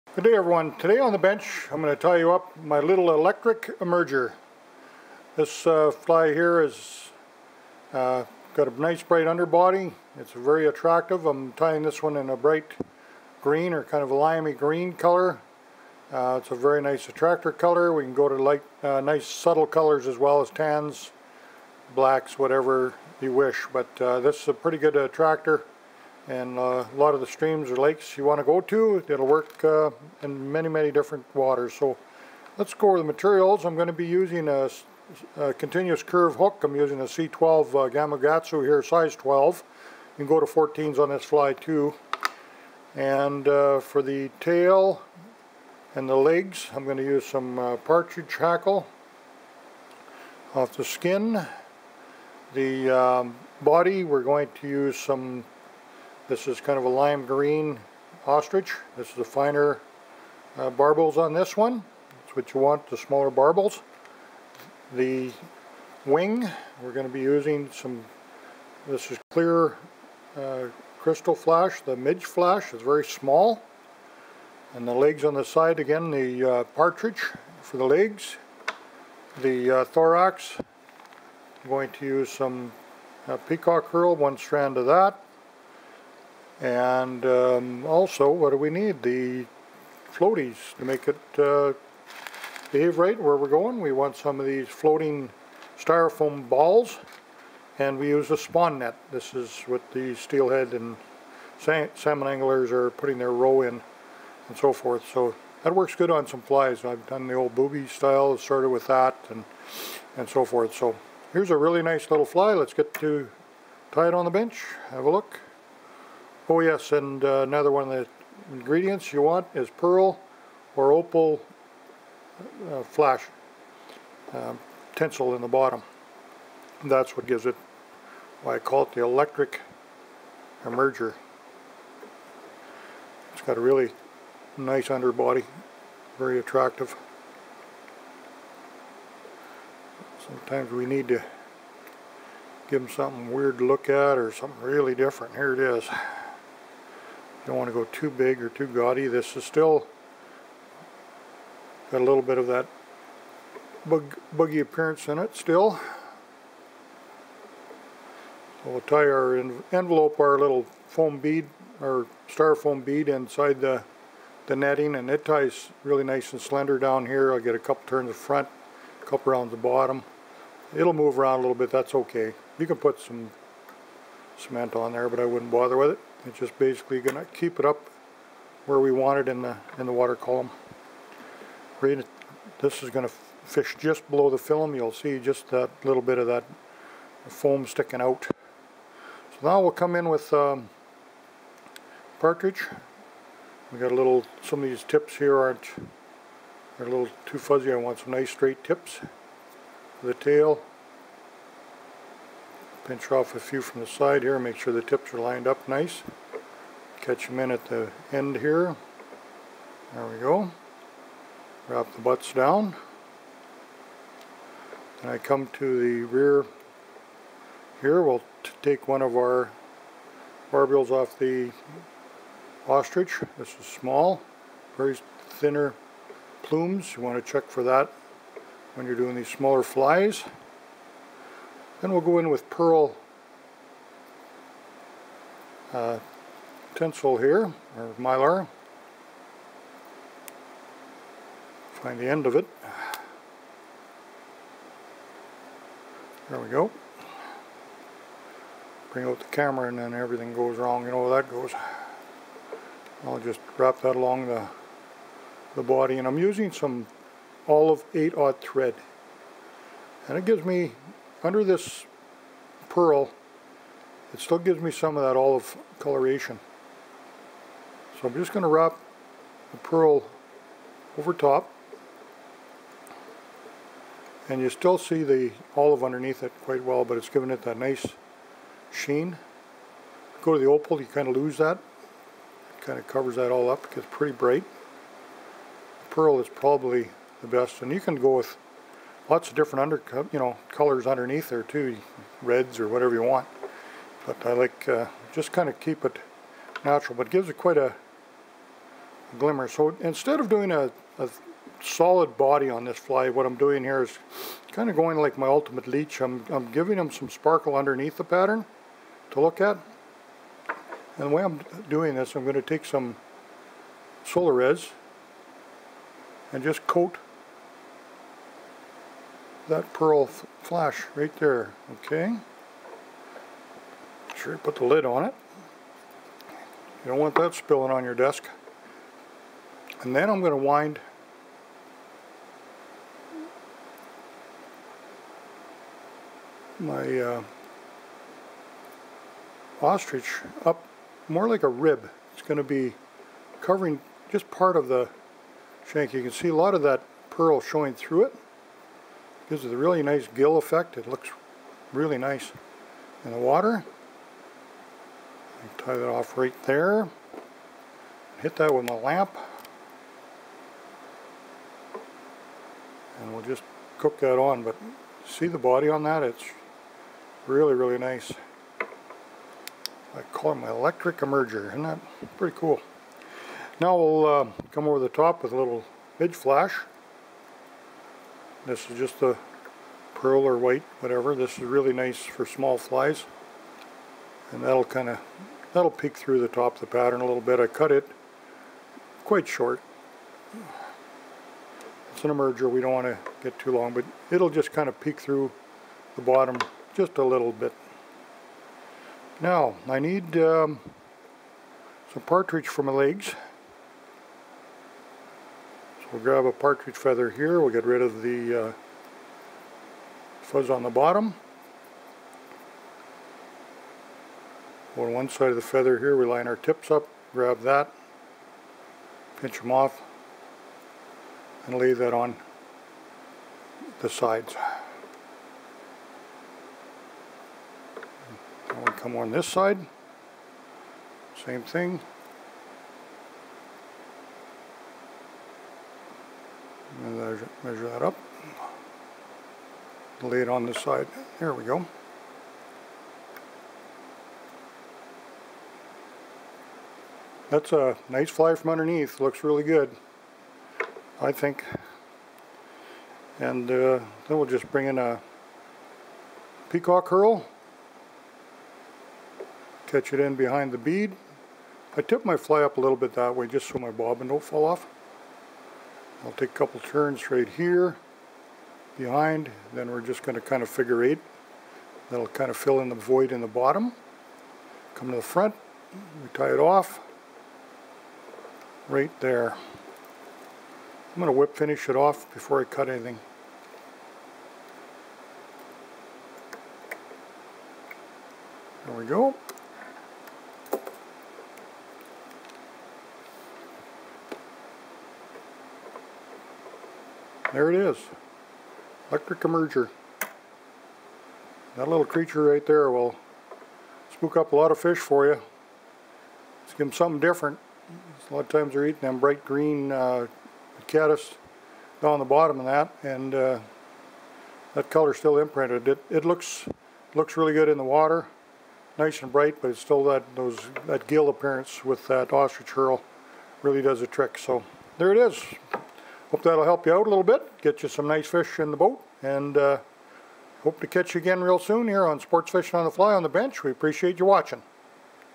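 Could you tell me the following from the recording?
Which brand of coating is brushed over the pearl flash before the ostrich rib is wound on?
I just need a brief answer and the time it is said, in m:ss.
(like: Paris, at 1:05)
Solarez, at 5:14.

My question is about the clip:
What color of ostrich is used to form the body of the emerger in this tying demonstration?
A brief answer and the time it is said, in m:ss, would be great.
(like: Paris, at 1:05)
Lime green, at 0:56.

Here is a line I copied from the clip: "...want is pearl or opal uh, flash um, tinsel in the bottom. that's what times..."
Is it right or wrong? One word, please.
wrong.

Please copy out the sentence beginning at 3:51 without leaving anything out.
Then we'll go in with pearl uh, tinsel here, or mylar.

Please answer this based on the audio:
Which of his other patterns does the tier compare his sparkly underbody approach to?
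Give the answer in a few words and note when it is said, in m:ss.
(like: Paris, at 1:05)
Ultimate leech, at 5:05.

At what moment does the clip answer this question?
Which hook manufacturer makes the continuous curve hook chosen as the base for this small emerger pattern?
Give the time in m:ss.
0:37.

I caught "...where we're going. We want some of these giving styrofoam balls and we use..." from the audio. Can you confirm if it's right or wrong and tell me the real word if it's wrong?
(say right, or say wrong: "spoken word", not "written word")
wrong: "floating", not "giving".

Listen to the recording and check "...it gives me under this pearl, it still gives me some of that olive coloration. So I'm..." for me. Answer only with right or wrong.
right.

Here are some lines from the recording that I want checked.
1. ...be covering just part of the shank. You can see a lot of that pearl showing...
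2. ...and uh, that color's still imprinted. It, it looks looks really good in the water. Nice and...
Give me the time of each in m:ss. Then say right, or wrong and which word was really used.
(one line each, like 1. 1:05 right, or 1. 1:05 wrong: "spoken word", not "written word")
1. 5:42 right
2. 8:32 right.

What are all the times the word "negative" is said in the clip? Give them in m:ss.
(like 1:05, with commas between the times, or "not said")
not said.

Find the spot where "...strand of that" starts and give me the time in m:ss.
1:24.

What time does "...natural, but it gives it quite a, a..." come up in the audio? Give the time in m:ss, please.
4:56.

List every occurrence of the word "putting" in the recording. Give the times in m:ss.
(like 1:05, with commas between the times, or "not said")
1:42.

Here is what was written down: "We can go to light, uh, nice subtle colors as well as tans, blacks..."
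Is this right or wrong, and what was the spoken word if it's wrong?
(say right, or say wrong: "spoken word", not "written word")
right.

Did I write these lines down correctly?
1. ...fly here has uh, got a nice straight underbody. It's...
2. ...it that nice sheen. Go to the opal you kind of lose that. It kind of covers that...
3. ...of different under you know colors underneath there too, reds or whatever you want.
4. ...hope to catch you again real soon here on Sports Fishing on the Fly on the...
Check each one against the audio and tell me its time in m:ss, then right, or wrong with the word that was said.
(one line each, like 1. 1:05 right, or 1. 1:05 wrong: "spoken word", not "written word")
1. 0:05 wrong: "bright", not "straight"
2. 4:37 right
3. 4:49 right
4. 8:50 right.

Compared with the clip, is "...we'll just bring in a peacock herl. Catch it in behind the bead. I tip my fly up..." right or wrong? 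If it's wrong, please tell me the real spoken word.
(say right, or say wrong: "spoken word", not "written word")
right.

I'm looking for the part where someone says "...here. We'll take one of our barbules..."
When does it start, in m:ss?
3:37.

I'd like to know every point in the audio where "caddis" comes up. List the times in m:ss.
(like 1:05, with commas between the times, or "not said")
8:30.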